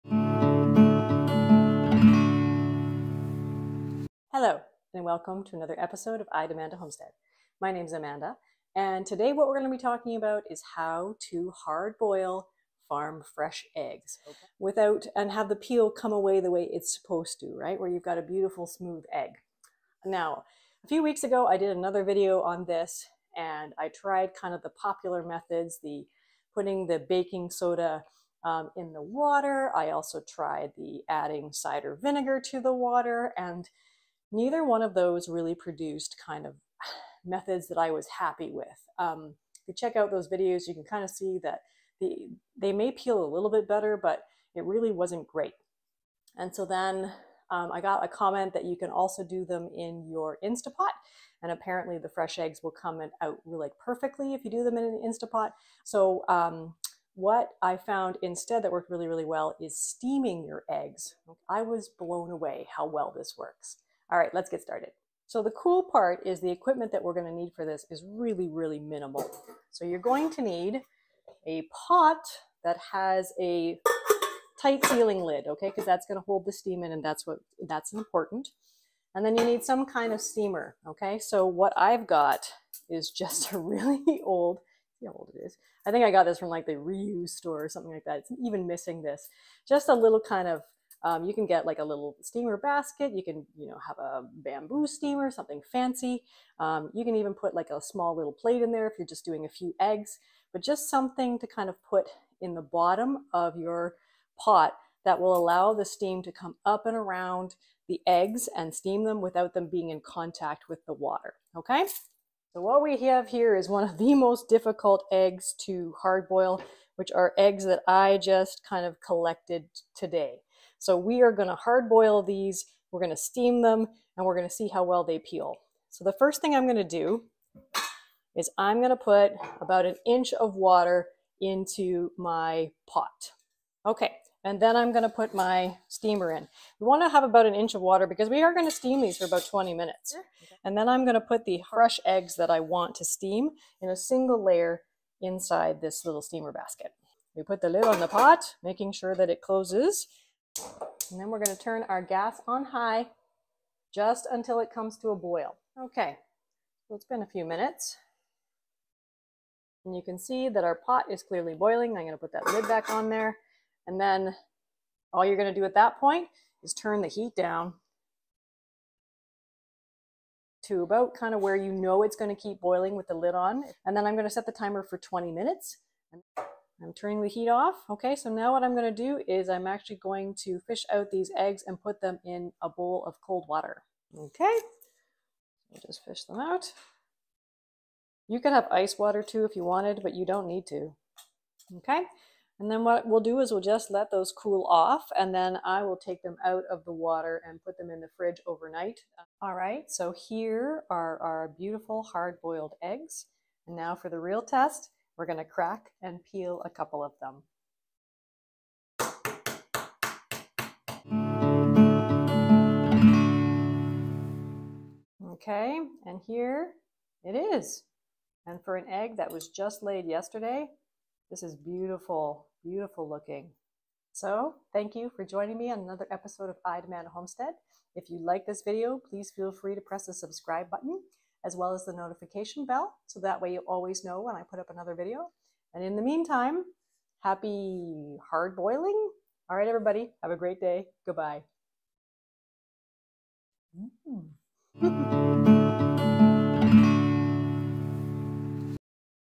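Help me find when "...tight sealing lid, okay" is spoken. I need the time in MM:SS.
01:14.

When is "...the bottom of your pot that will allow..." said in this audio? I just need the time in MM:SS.
01:42.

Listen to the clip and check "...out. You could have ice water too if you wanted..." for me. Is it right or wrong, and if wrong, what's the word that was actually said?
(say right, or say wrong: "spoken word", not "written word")
right.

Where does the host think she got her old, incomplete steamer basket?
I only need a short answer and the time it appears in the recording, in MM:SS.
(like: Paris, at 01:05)
the reuse store, at 01:26.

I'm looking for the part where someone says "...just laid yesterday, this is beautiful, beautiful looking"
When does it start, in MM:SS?
03:39.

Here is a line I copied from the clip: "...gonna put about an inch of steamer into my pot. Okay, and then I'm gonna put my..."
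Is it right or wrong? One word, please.
wrong.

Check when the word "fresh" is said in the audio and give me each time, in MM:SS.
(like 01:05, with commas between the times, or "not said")
00:13, 00:52, 02:21.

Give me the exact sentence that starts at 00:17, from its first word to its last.
Where you've got a beautiful smooth egg.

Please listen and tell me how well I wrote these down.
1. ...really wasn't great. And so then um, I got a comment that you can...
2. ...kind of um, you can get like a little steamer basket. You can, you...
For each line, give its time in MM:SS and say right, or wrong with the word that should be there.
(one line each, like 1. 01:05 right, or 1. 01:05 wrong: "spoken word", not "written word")
1. 00:44 right
2. 01:30 right.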